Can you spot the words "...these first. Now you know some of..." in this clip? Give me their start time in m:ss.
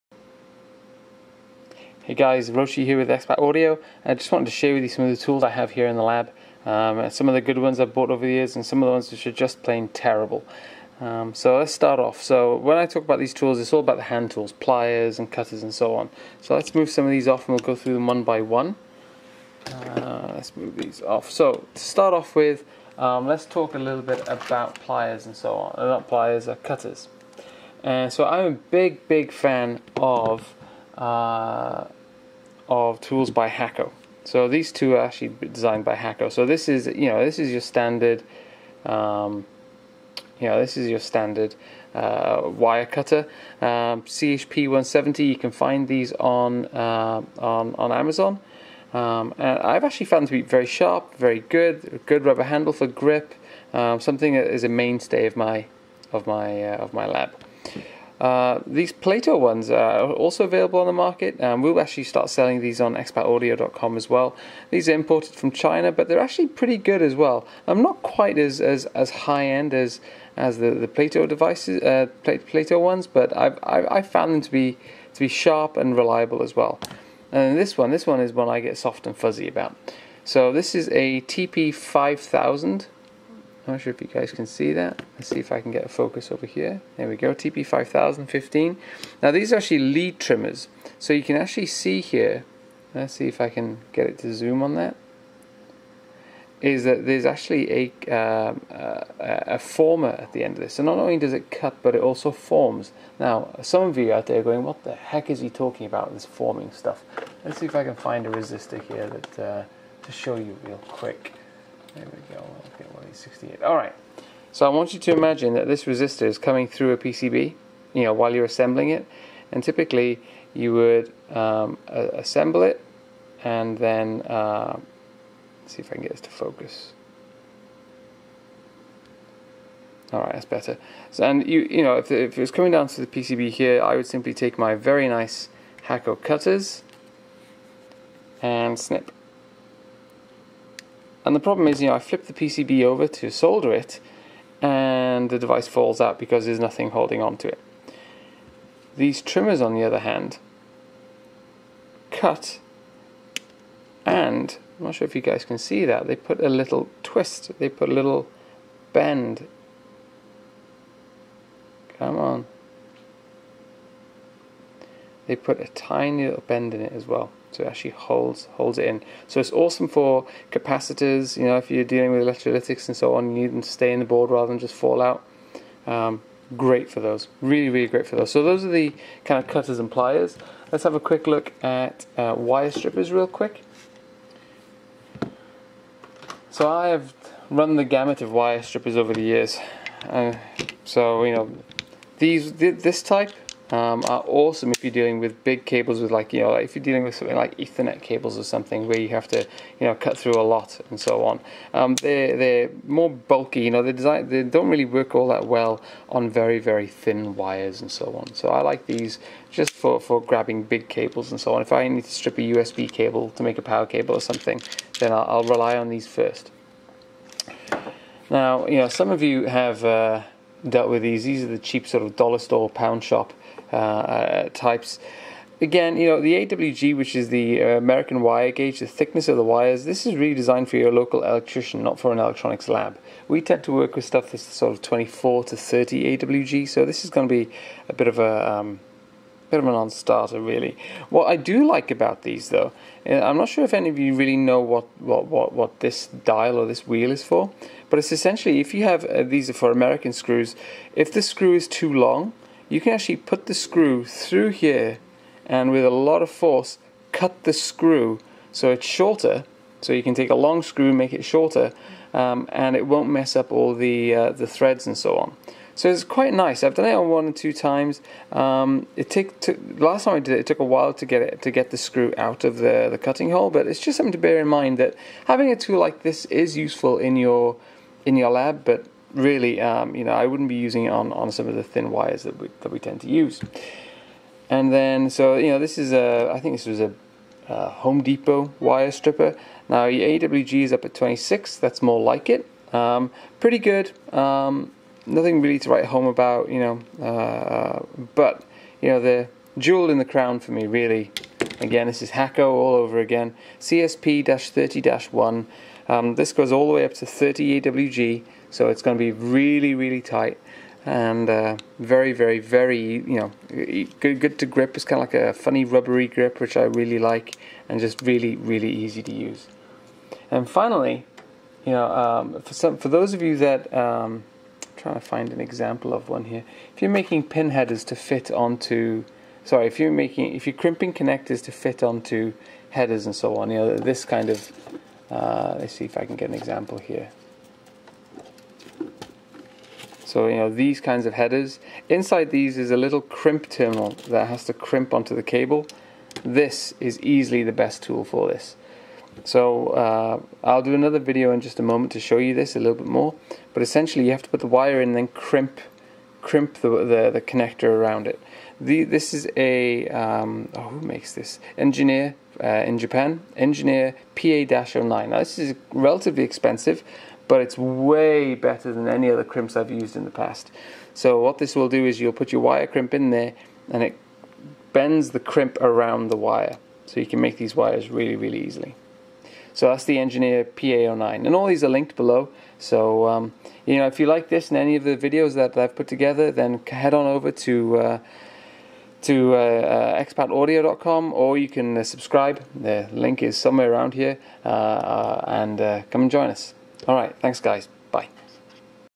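3:35.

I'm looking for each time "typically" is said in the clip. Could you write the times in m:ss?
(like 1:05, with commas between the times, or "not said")
1:59.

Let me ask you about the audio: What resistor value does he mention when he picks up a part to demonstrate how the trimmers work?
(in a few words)
68.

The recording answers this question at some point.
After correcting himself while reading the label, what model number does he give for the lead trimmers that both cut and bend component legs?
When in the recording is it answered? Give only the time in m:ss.
1:27.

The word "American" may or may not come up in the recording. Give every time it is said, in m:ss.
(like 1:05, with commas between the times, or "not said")
3:47, 4:09.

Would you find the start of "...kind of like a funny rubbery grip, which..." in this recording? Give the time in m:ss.
5:14.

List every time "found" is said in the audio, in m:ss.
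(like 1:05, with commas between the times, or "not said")
0:50, 1:14.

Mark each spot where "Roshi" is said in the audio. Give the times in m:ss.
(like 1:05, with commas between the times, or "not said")
0:02.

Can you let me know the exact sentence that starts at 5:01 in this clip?
Again, this is Hakko all over again, CSP-30-1.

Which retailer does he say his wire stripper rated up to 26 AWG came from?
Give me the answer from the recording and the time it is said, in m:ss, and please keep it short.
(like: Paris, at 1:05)
Home Depot, at 4:47.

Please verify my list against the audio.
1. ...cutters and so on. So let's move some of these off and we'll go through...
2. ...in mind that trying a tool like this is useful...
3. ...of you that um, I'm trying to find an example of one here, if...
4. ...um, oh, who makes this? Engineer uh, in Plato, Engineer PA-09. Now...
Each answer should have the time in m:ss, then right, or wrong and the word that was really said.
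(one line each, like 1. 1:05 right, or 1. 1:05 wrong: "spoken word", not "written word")
1. 0:15 right
2. 4:34 wrong: "having", not "trying"
3. 5:23 right
4. 5:59 wrong: "Japan", not "Plato".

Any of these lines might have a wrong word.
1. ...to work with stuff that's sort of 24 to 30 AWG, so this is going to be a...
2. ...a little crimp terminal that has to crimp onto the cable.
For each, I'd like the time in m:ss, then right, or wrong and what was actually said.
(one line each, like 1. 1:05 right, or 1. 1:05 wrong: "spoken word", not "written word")
1. 3:53 right
2. 5:42 right.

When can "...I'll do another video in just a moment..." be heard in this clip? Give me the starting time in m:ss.
5:50.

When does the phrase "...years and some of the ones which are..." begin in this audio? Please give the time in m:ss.
0:08.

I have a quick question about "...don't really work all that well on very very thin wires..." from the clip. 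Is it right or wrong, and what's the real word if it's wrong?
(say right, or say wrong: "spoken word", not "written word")
right.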